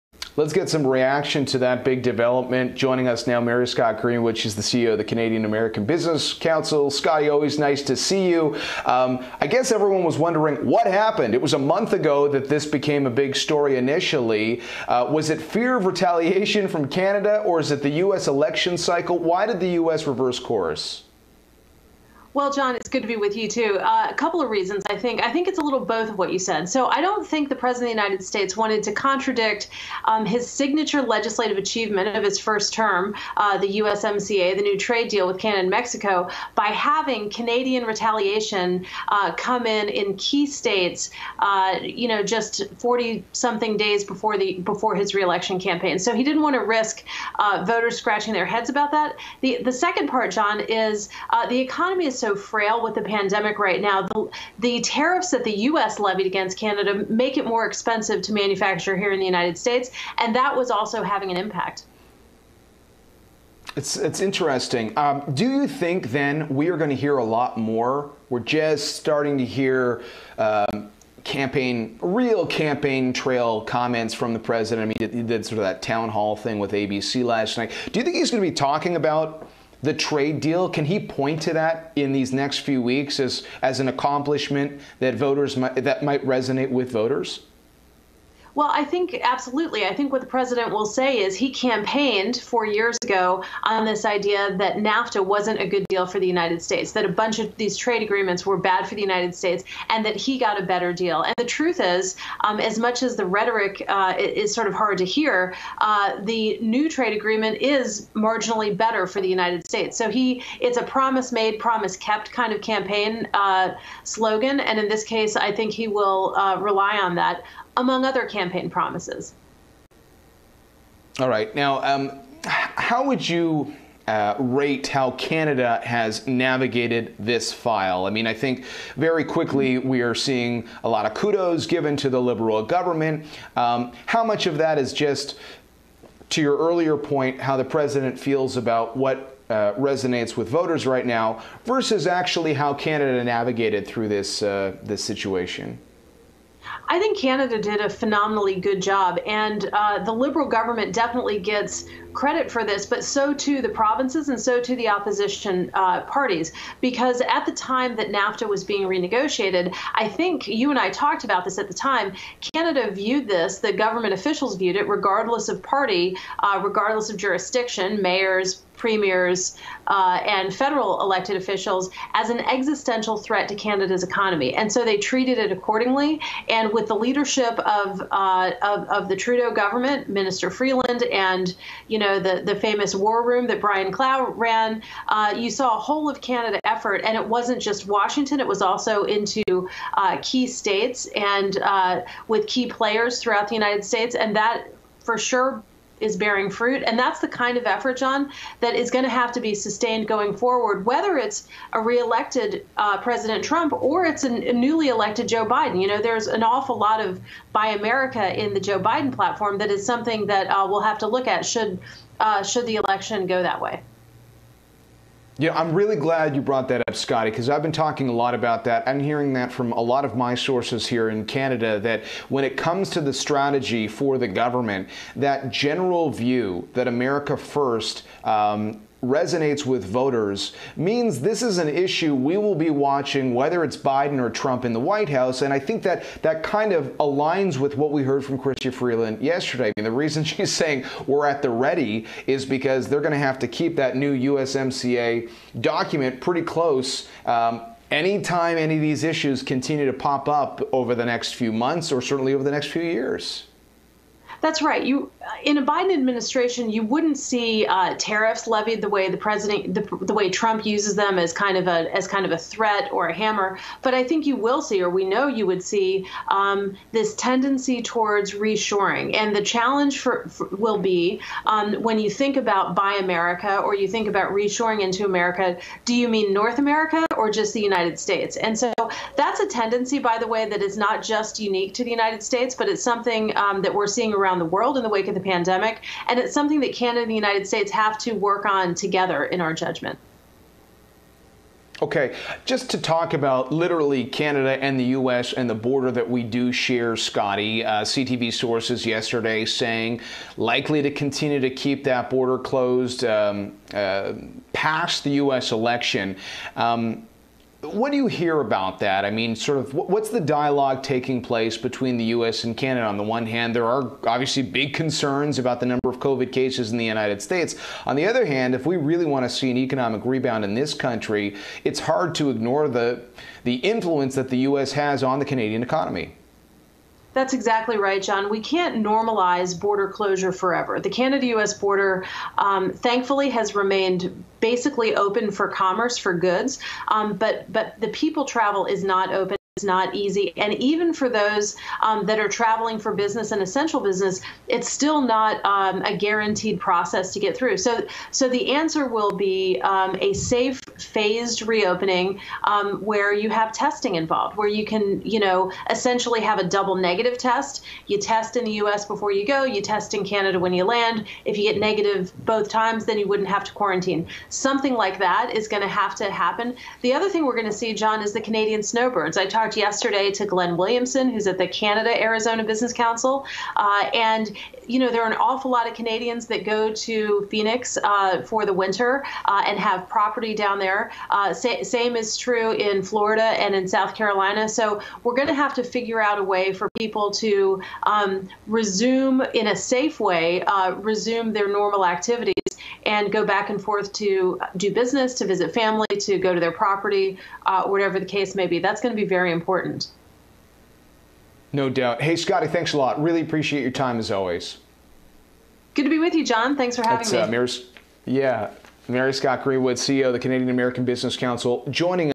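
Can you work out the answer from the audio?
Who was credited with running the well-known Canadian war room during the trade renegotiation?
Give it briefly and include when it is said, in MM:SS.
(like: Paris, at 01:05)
Brian Clow, at 03:03.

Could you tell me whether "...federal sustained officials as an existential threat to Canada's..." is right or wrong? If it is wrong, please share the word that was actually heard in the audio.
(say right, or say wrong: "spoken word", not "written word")
wrong: "elected", not "sustained".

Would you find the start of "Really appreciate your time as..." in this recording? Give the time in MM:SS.
06:43.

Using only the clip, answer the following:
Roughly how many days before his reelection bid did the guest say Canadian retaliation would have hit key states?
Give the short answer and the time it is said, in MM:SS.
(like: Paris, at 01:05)
40 something days, at 00:42.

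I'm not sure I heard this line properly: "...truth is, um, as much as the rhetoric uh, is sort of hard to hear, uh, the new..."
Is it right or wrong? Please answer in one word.
right.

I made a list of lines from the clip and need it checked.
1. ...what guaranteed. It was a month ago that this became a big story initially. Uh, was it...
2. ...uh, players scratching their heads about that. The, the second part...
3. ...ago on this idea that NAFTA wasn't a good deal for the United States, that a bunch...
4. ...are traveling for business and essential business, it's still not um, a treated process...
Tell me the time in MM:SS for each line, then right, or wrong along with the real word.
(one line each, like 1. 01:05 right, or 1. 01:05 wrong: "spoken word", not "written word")
1. 00:10 wrong: "happened", not "guaranteed"
2. 00:47 wrong: "voters", not "players"
3. 01:33 right
4. 05:42 wrong: "guaranteed", not "treated".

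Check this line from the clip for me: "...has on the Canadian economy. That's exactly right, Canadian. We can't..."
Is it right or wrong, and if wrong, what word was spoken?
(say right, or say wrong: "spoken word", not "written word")
wrong: "John", not "Canadian".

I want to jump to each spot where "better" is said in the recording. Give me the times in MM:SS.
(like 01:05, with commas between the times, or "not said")
01:40, 01:48.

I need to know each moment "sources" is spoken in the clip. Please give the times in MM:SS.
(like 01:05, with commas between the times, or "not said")
03:40, 04:58.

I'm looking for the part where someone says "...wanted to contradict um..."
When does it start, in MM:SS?
00:28.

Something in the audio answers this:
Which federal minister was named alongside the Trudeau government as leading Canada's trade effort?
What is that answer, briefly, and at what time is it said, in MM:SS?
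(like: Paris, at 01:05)
Minister Freeland, at 03:00.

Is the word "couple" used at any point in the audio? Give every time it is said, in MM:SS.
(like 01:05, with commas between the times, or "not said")
00:24.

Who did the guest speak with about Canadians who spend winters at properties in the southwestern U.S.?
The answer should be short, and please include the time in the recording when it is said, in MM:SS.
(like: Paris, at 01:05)
Glenn Williamson, at 06:10.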